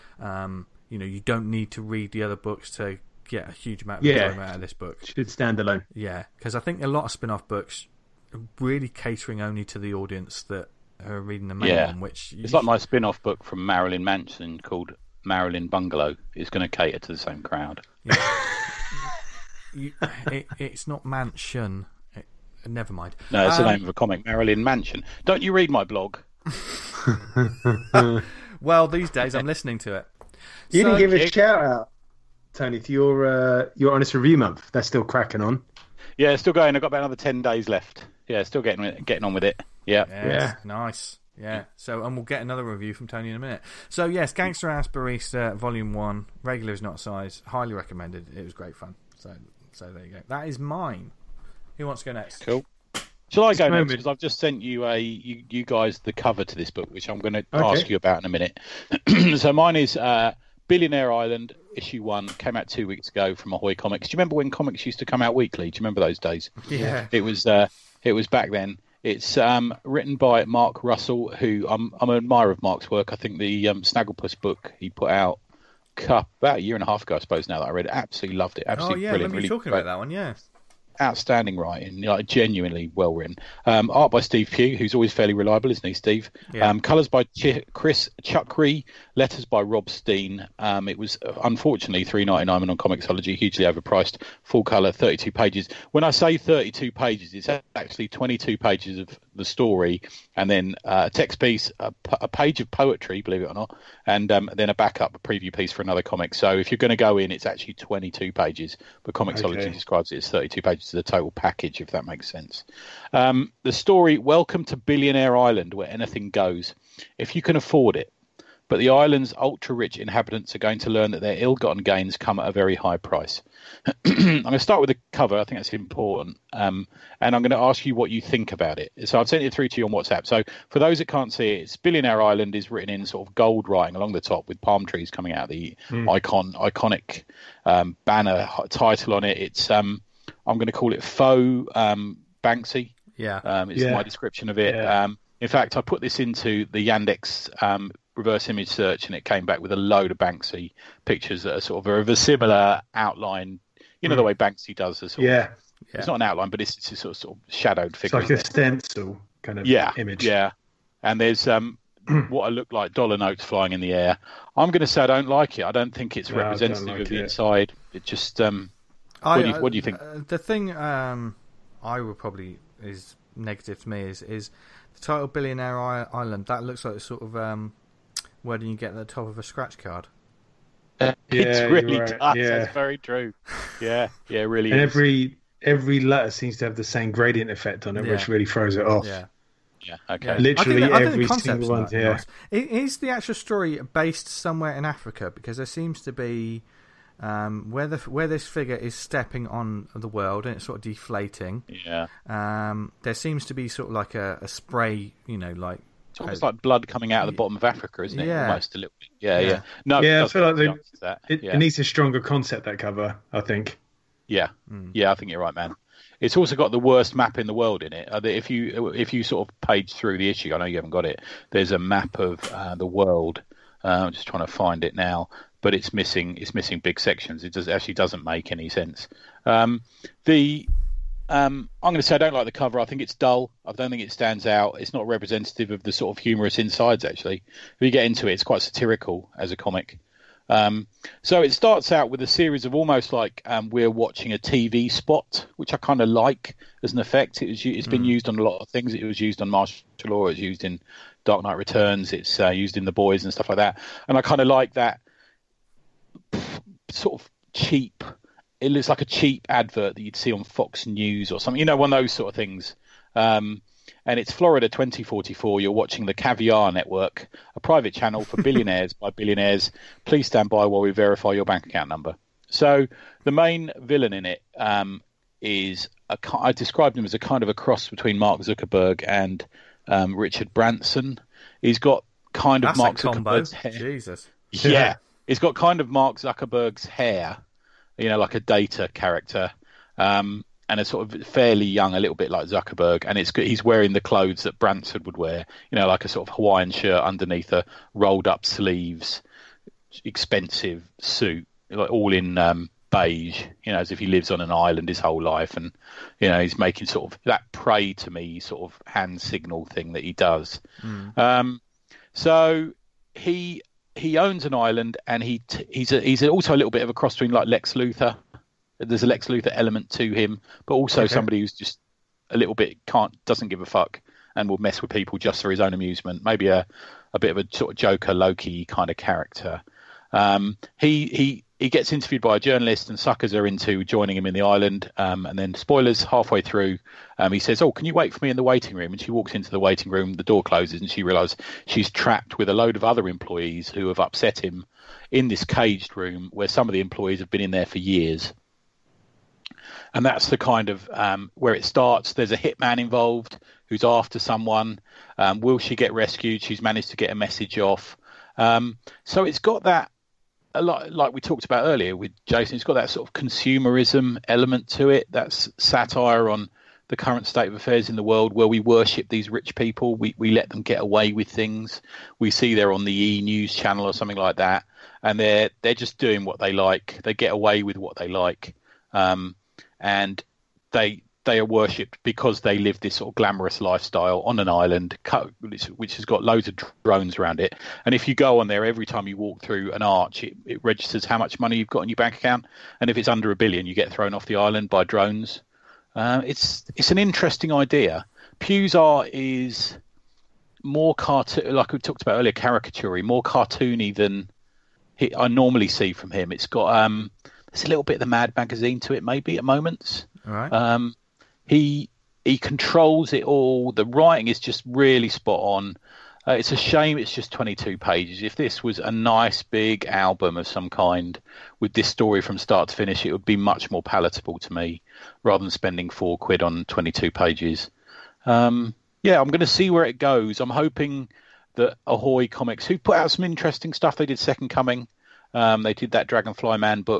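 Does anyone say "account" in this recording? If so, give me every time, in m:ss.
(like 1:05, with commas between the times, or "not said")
4:31, 6:32.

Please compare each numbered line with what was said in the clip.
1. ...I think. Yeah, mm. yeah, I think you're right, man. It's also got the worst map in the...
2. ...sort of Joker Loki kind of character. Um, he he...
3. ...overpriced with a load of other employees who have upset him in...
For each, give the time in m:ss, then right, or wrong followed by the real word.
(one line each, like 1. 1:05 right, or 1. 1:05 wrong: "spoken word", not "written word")
1. 3:33 right
2. 5:27 right
3. 5:41 wrong: "trapped", not "overpriced".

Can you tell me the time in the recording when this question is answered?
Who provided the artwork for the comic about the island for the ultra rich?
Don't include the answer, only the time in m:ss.
1:24.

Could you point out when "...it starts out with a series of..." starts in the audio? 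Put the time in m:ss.
4:01.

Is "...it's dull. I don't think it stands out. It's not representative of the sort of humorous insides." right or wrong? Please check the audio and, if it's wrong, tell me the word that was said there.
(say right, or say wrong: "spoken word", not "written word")
right.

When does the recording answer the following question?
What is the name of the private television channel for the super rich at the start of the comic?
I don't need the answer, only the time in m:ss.
4:26.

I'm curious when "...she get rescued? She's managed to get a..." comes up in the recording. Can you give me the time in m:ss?
5:55.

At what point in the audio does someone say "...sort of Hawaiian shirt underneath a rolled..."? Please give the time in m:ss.
4:56.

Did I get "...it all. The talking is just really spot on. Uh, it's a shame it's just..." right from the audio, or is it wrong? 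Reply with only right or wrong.
wrong.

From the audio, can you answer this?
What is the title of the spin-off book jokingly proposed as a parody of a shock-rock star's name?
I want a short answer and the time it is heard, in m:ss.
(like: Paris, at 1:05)
Marilyn Bungalow, at 0:15.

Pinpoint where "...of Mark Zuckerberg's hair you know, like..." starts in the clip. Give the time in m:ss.
4:45.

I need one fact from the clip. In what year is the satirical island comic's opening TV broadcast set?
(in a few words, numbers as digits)
2044.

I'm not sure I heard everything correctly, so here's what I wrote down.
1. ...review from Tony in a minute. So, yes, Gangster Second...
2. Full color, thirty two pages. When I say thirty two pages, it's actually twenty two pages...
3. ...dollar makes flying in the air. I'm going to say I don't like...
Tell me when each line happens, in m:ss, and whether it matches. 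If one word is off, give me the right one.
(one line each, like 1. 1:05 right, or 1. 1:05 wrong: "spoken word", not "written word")
1. 0:42 wrong: "Ass", not "Second"
2. 1:34 right
3. 2:42 wrong: "notes", not "makes".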